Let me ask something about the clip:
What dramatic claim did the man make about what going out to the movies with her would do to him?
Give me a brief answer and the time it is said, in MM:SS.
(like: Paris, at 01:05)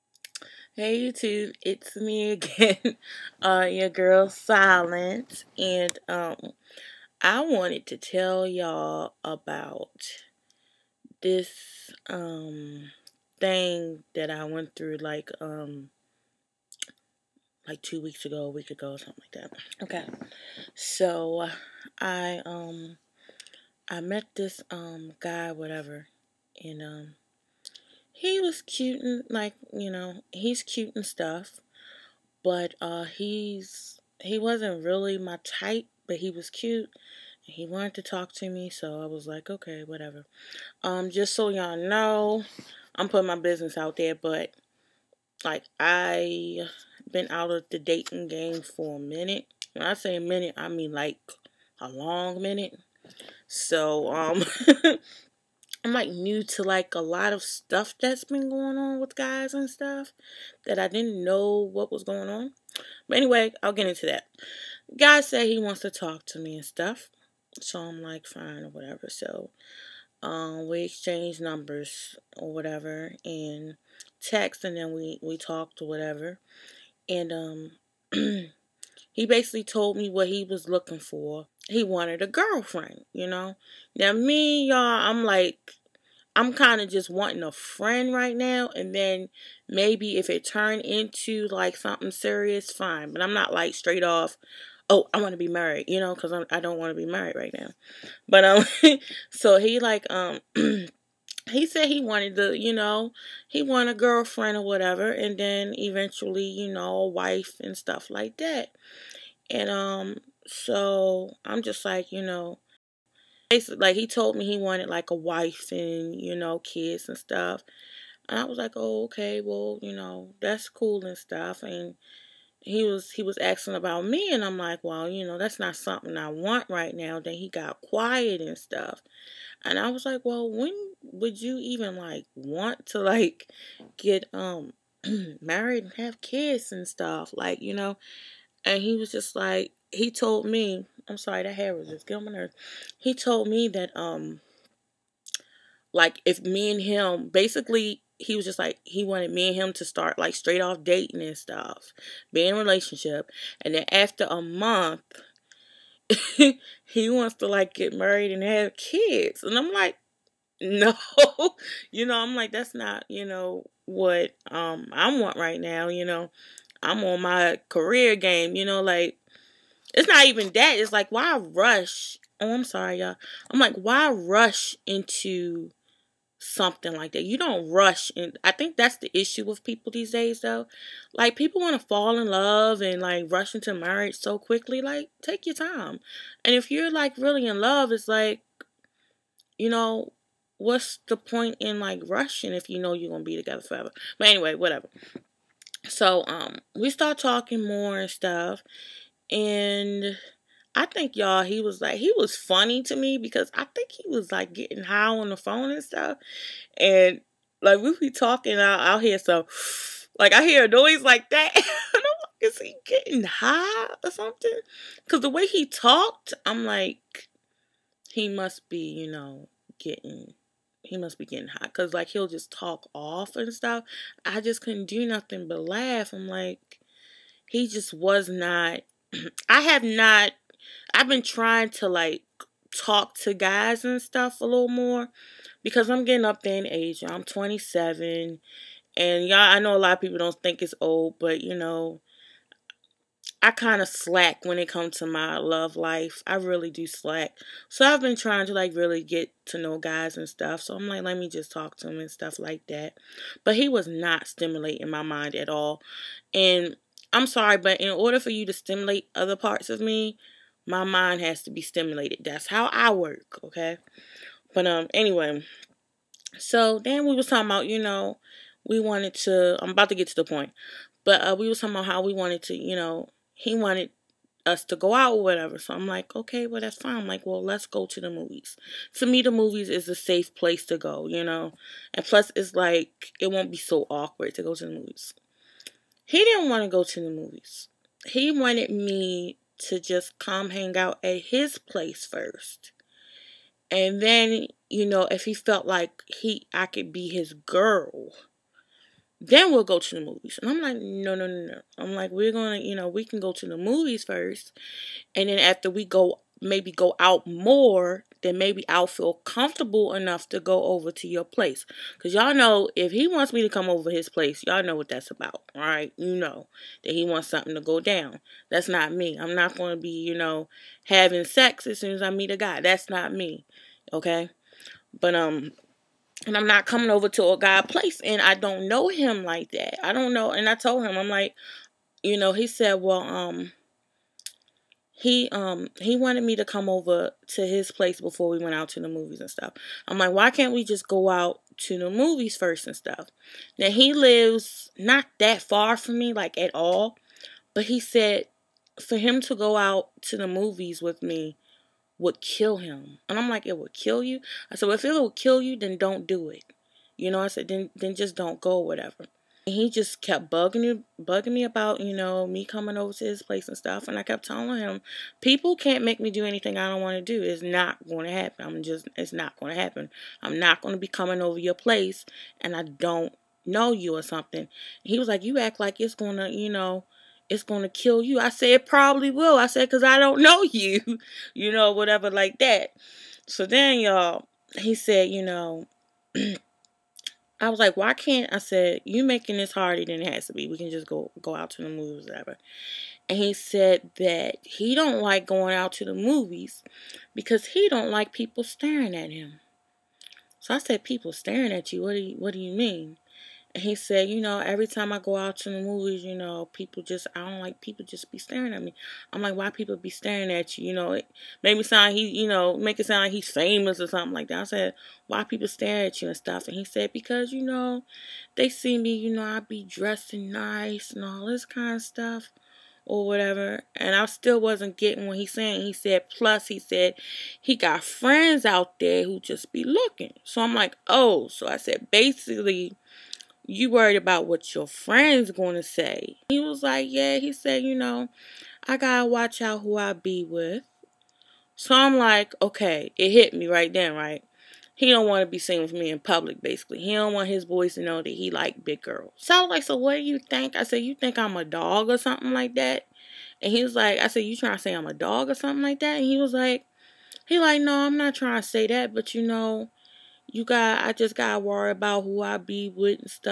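kill him, at 05:52.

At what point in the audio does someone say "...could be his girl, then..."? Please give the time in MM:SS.
04:56.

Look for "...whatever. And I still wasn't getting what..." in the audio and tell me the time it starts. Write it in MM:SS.
07:03.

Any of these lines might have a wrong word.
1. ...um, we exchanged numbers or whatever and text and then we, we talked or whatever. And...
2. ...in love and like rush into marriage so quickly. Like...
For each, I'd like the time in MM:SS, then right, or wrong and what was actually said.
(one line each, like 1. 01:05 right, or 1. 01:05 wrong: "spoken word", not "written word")
1. 01:10 right
2. 03:02 right.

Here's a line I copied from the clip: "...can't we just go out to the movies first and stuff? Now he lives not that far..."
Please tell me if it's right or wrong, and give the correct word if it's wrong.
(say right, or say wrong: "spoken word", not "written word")
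right.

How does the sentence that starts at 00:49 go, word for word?
When I say a minute, I mean like a long minute.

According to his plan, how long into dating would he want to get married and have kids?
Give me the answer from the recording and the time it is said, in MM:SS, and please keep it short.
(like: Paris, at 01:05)
a month, at 02:34.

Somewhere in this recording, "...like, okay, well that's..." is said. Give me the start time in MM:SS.
04:35.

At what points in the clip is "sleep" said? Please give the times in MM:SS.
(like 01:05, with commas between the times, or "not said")
not said.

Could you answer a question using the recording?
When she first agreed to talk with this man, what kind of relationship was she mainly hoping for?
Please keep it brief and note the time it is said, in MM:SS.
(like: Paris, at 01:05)
a friend, at 01:27.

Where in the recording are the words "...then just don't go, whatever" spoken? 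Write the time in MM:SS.
05:57.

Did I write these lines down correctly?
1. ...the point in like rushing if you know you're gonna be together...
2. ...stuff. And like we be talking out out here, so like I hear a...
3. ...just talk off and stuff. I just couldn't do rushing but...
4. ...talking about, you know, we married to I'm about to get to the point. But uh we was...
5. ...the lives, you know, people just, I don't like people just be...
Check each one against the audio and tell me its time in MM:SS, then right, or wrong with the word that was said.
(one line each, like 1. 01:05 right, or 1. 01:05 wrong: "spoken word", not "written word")
1. 03:11 right
2. 03:25 right
3. 03:42 wrong: "nothing", not "rushing"
4. 04:27 wrong: "wanted", not "married"
5. 06:45 wrong: "movies", not "lives".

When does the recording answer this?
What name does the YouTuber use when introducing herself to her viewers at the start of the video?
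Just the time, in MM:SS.
00:04.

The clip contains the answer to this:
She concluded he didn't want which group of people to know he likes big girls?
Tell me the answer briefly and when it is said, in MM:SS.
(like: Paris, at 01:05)
his boys, at 07:27.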